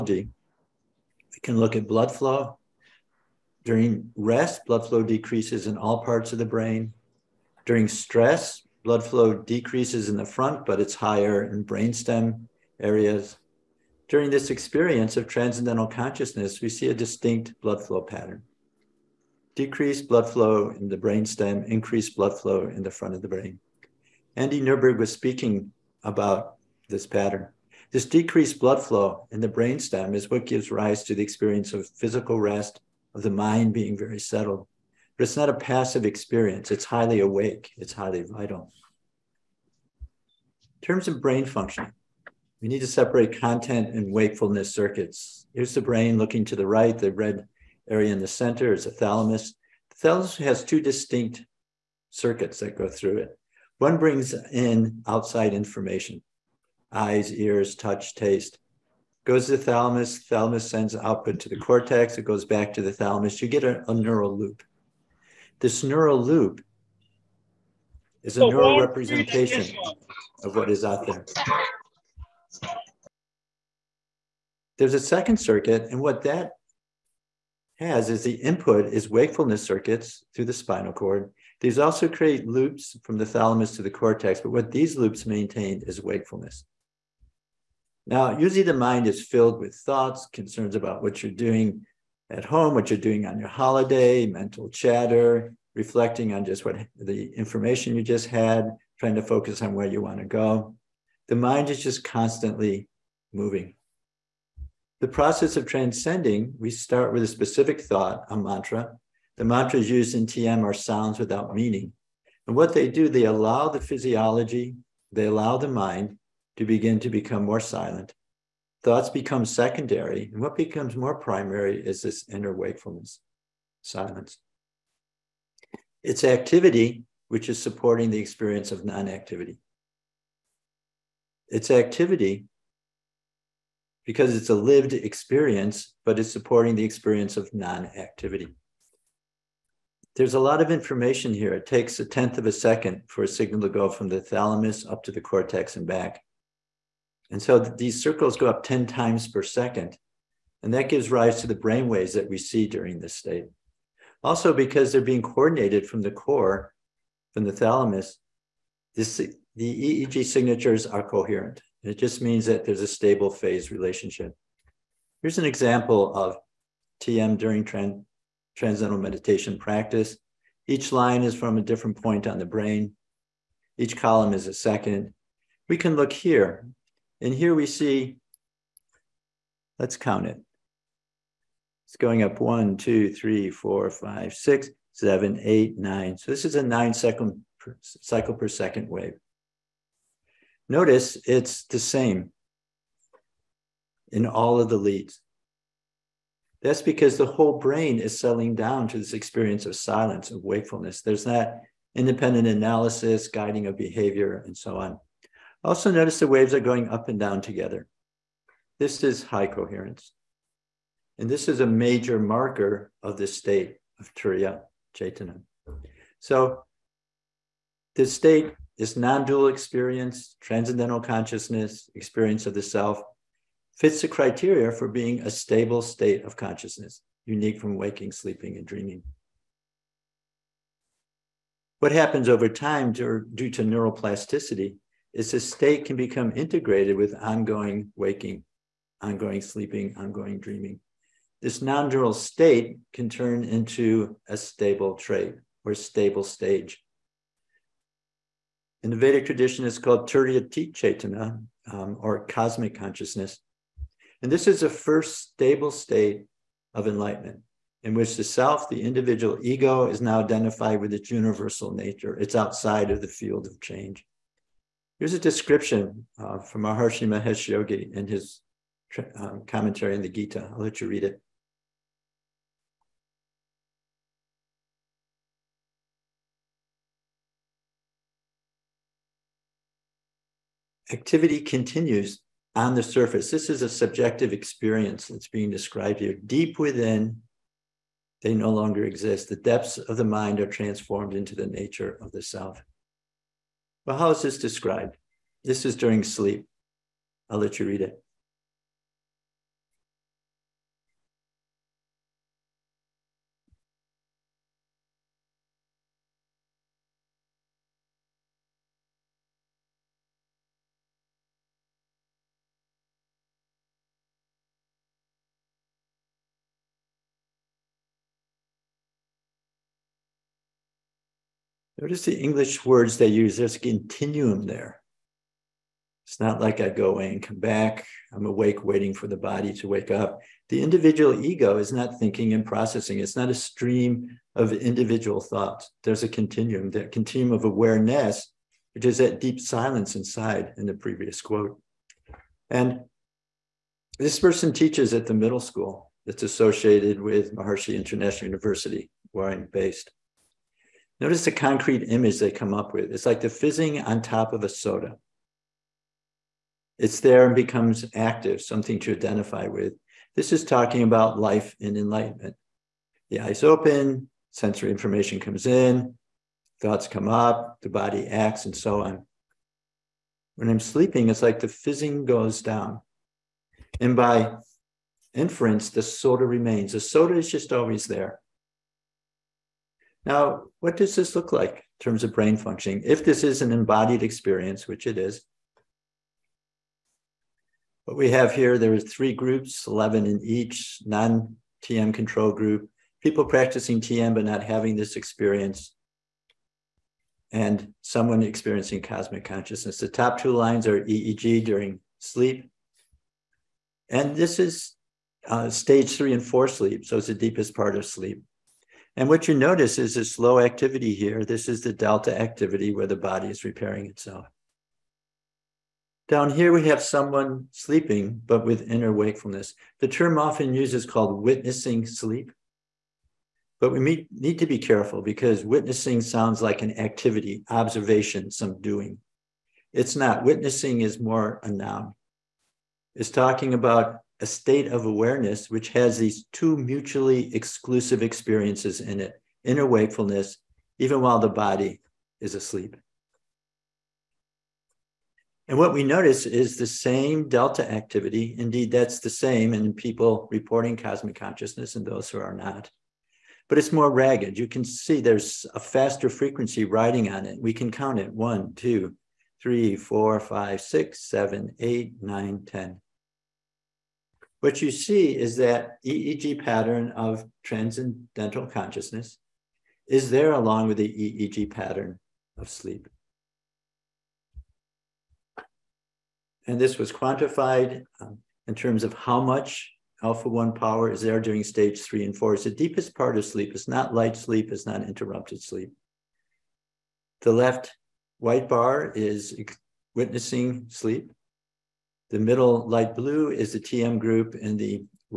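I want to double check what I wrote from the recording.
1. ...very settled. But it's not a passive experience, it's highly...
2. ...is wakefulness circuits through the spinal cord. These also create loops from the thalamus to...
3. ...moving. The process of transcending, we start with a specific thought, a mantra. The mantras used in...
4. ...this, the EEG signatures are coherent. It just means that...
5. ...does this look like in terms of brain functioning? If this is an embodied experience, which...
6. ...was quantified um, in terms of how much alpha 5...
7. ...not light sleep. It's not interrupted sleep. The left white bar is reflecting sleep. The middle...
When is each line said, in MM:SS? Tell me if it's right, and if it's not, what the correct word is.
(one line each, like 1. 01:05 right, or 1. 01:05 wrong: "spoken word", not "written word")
1. 00:33 right
2. 01:18 right
3. 01:43 right
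4. 02:38 right
5. 06:20 right
6. 07:56 wrong: "1", not "5"
7. 08:03 wrong: "witnessing", not "reflecting".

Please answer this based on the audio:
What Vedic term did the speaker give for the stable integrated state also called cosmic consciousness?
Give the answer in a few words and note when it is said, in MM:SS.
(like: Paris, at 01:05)
Turiyatita Chaitanya, at 04:10.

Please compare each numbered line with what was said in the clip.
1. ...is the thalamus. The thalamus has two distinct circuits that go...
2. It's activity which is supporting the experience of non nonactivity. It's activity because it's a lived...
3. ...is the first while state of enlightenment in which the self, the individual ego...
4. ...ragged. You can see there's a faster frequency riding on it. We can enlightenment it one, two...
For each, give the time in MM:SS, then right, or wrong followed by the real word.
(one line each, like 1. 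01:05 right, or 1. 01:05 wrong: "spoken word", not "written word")
1. 00:48 right
2. 02:06 wrong: "activity", not "nonactivity"
3. 04:14 wrong: "stable", not "while"
4. 07:33 wrong: "count", not "enlightenment".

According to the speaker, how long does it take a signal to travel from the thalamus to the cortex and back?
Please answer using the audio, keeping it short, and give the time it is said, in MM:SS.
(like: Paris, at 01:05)
A tenth of a second, at 02:22.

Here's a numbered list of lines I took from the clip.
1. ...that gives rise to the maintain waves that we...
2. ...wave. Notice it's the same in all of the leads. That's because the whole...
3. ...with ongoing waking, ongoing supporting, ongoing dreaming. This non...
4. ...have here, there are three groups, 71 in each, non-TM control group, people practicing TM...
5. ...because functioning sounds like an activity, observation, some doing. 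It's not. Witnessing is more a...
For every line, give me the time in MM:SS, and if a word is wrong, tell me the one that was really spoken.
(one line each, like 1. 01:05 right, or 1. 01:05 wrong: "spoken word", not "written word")
1. 02:30 wrong: "brain", not "maintain"
2. 03:08 right
3. 03:56 wrong: "sleeping", not "supporting"
4. 06:28 wrong: "11", not "71"
5. 07:05 wrong: "witnessing", not "functioning".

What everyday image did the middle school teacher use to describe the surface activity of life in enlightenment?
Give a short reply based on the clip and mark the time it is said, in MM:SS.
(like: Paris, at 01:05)
Fizzing on top of a soda, at 05:53.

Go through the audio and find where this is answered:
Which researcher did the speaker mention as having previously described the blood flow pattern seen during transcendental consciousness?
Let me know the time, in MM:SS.
00:24.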